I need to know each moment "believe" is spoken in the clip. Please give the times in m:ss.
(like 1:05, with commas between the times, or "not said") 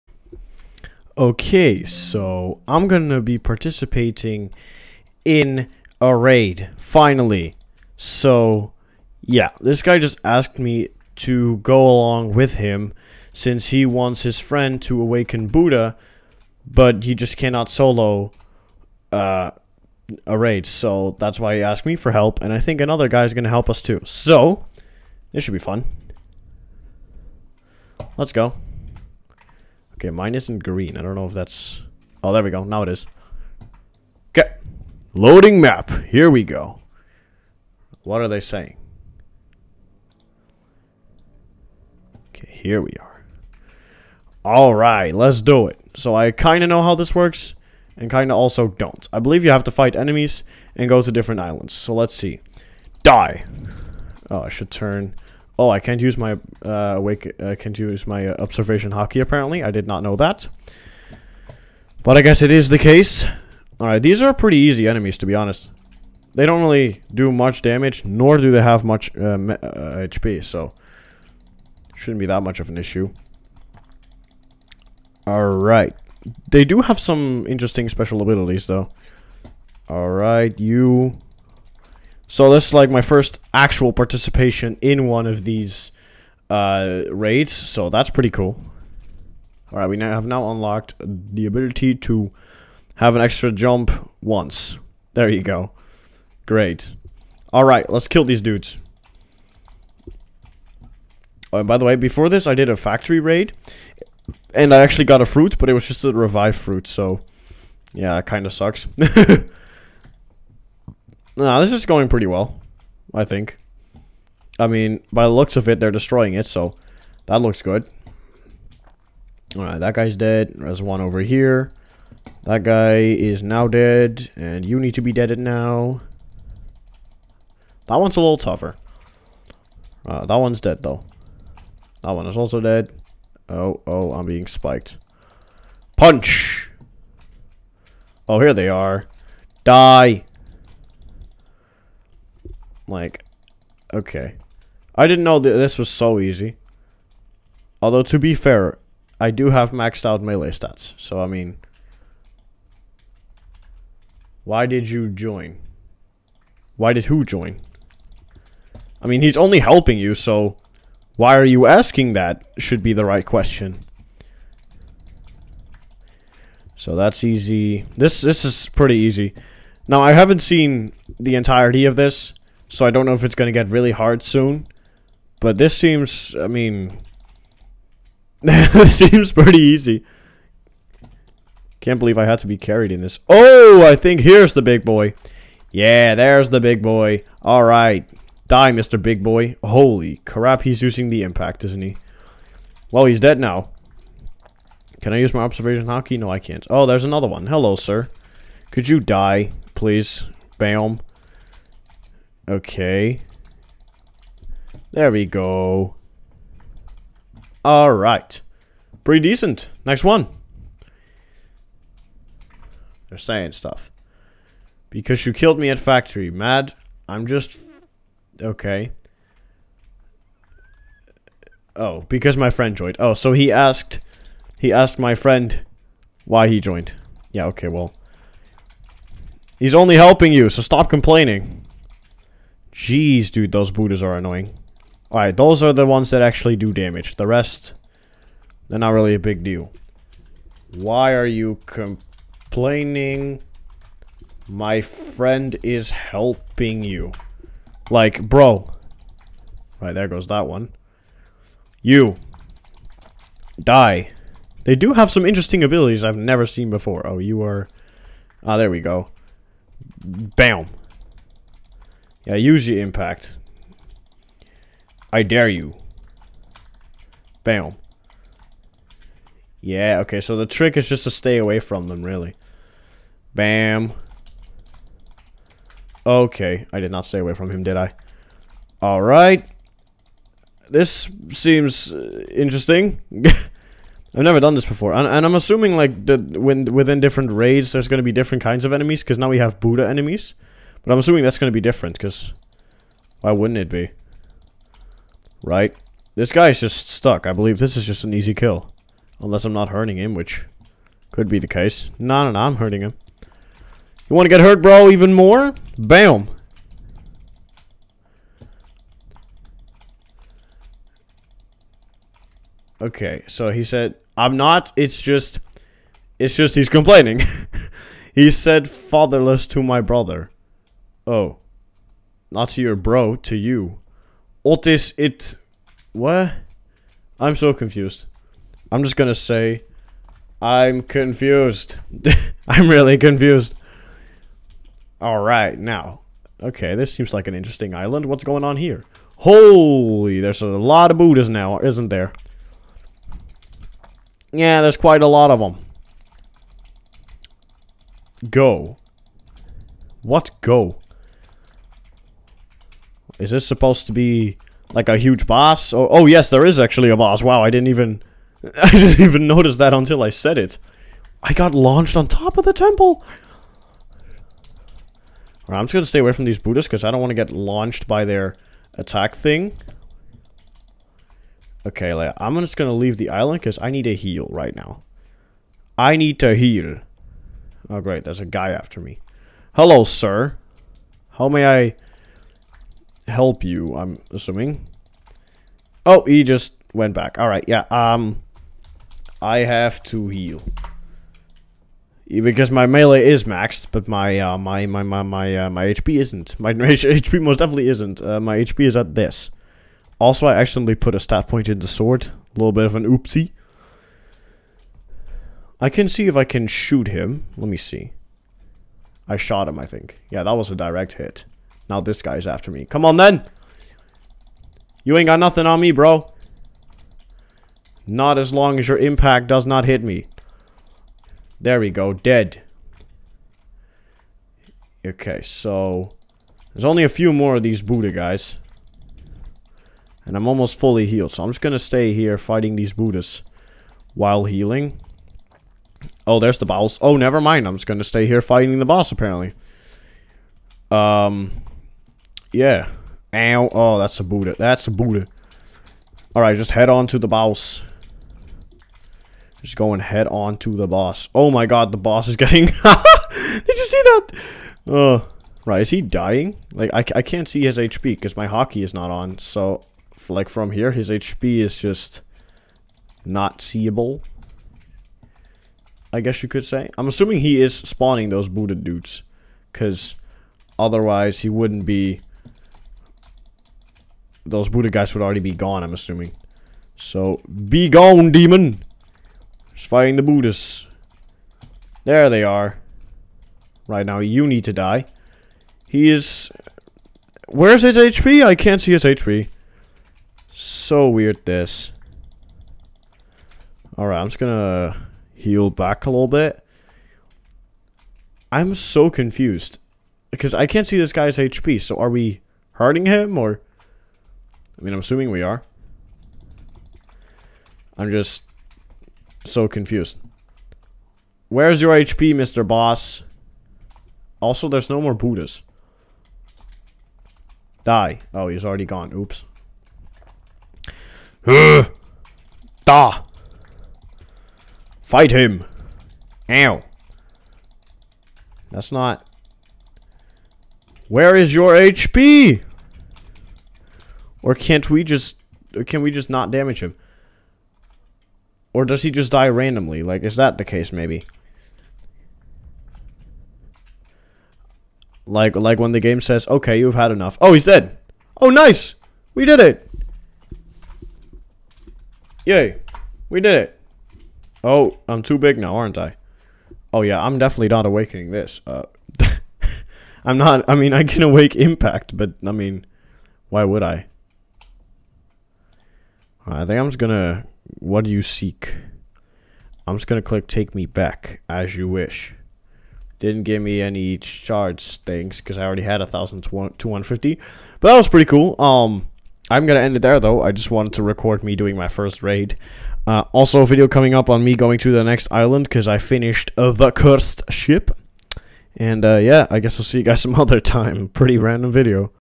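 0:49, 3:01, 4:57.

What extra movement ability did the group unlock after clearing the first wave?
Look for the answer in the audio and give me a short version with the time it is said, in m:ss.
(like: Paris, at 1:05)
An extra jump, at 1:33.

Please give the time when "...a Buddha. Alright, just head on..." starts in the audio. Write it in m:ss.
7:24.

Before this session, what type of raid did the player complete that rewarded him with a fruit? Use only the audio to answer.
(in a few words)
Factory raid.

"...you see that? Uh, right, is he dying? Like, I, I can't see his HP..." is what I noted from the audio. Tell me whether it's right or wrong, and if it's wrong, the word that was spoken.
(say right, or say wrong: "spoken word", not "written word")
right.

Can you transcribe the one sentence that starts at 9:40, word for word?
I just wanted to record me doing my first raid.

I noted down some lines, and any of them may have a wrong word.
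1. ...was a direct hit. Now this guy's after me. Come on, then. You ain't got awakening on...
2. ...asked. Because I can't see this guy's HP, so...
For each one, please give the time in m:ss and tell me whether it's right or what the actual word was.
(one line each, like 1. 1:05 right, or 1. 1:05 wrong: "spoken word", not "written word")
1. 6:50 wrong: "nothing", not "awakening"
2. 8:18 wrong: "confused", not "asked".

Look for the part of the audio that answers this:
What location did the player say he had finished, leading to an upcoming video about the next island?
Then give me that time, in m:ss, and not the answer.
9:46.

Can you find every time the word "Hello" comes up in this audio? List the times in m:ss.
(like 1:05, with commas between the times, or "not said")
3:17, 6:19.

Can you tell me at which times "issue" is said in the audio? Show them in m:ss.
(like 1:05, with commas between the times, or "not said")
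1:12.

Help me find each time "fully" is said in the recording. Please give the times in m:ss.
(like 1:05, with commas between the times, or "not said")
7:10.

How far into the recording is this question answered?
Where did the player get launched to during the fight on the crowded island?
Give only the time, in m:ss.
6:01.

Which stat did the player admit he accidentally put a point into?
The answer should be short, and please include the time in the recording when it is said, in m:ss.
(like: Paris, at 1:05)
Sword, at 6:41.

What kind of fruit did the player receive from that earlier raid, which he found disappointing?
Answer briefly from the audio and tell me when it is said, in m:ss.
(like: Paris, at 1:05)
Revive fruit, at 1:46.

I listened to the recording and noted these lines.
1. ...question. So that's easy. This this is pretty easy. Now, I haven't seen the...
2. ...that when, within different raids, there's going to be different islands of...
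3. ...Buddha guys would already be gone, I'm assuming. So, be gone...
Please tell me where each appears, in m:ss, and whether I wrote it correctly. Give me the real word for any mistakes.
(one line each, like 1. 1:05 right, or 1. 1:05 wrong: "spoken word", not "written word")
1. 2:43 right
2. 4:46 wrong: "kinds", not "islands"
3. 7:54 right.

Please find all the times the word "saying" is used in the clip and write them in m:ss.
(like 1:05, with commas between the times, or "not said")
0:38, 3:33.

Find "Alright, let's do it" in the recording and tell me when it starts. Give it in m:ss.
0:44.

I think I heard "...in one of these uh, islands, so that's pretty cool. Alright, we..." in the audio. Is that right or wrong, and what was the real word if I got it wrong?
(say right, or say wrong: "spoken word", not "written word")
wrong: "raids", not "islands".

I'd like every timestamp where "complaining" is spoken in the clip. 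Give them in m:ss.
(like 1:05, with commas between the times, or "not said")
3:50, 4:01, 5:16.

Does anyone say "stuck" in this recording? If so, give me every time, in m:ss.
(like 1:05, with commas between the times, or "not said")
4:56.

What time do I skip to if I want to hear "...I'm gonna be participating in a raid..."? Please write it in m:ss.
0:02.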